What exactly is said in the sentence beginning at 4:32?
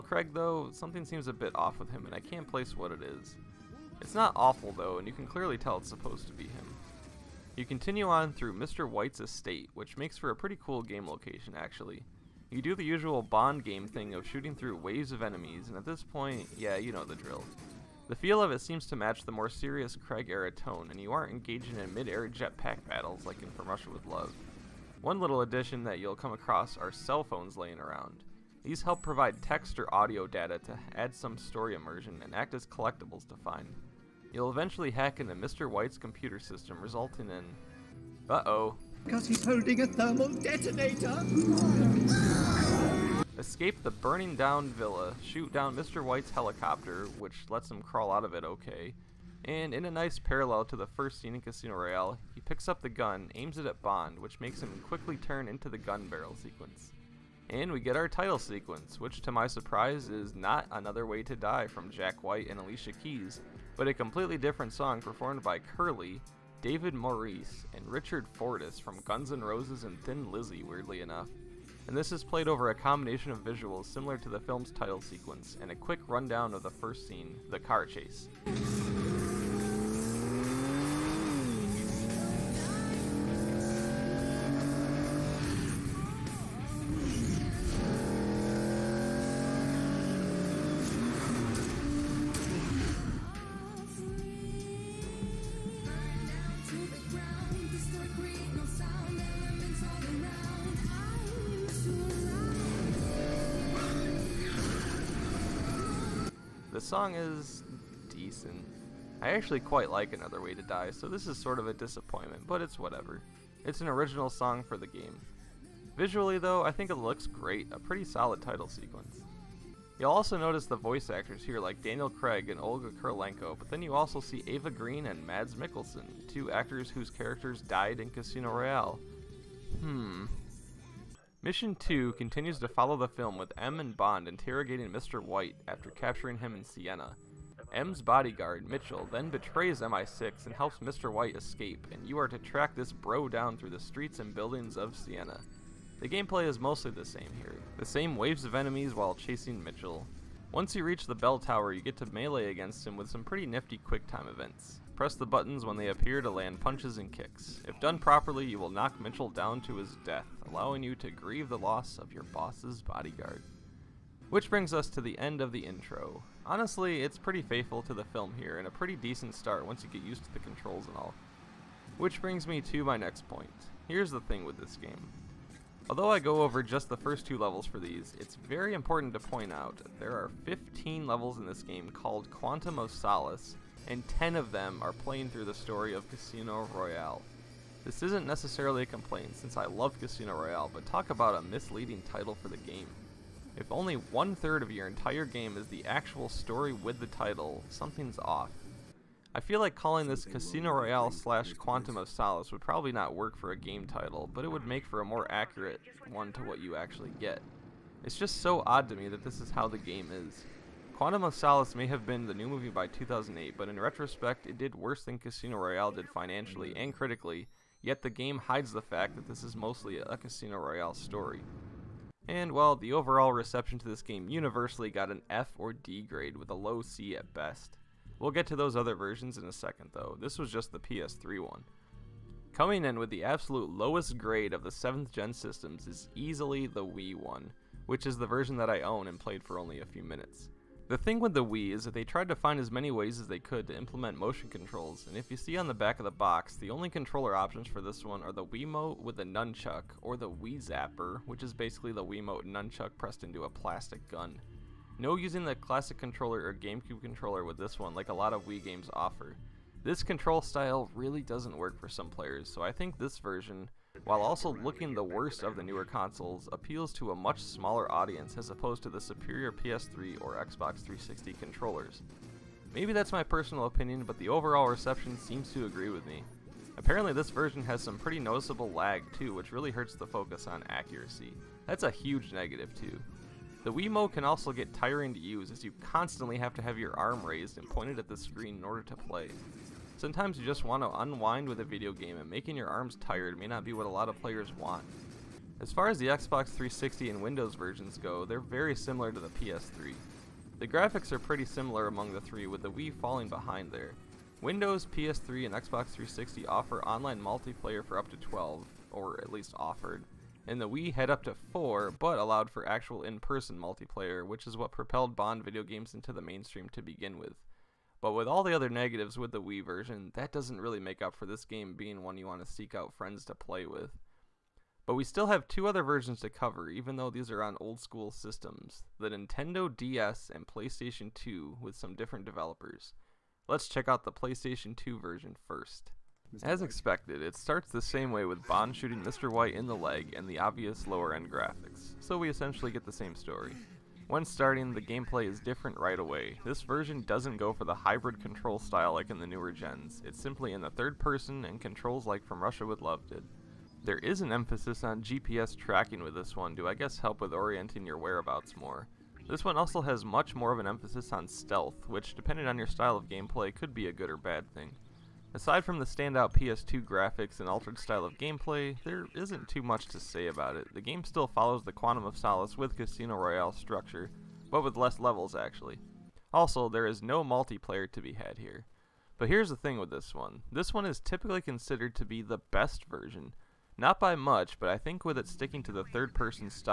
Maybe that's my personal opinion, but the overall reception seems to agree with me.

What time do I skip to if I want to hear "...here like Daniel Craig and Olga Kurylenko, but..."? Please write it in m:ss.
2:01.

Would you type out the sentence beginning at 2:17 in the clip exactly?
M's bodyguard, Mitchell, then betrays MI6 and helps Mr.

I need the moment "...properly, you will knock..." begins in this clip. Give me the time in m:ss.
2:37.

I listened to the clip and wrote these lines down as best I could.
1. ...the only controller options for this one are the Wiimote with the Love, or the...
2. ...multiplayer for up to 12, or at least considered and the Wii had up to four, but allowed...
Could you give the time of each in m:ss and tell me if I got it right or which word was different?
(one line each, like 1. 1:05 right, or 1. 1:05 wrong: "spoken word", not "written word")
1. 4:06 wrong: "Nunchuk", not "Love"
2. 5:07 wrong: "offered", not "considered".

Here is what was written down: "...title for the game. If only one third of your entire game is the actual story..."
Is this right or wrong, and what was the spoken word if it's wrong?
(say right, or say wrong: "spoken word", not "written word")
right.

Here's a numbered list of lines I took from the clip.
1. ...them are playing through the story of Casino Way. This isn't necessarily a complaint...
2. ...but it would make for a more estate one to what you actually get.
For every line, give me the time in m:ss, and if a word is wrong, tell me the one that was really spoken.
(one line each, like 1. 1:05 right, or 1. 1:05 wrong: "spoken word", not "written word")
1. 3:04 wrong: "Royale", not "Way"
2. 3:24 wrong: "accurate", not "estate".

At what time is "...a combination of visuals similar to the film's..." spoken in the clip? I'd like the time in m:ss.
1:12.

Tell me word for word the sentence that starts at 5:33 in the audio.
Let's check out the PlayStation 2 version first.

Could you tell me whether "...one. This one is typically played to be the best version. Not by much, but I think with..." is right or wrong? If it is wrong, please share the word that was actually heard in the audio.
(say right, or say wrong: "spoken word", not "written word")
wrong: "considered", not "played".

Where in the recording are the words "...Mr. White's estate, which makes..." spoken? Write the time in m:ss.
0:08.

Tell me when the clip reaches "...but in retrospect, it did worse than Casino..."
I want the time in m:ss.
3:33.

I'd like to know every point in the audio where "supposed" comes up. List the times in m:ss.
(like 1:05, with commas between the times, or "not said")
0:05.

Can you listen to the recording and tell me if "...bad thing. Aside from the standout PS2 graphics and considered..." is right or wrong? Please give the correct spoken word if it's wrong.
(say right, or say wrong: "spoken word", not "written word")
wrong: "altered", not "considered".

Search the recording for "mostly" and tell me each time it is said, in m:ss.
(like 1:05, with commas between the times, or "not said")
2:26, 3:39.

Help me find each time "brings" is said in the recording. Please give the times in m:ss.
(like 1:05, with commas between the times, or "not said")
2:44, 2:52.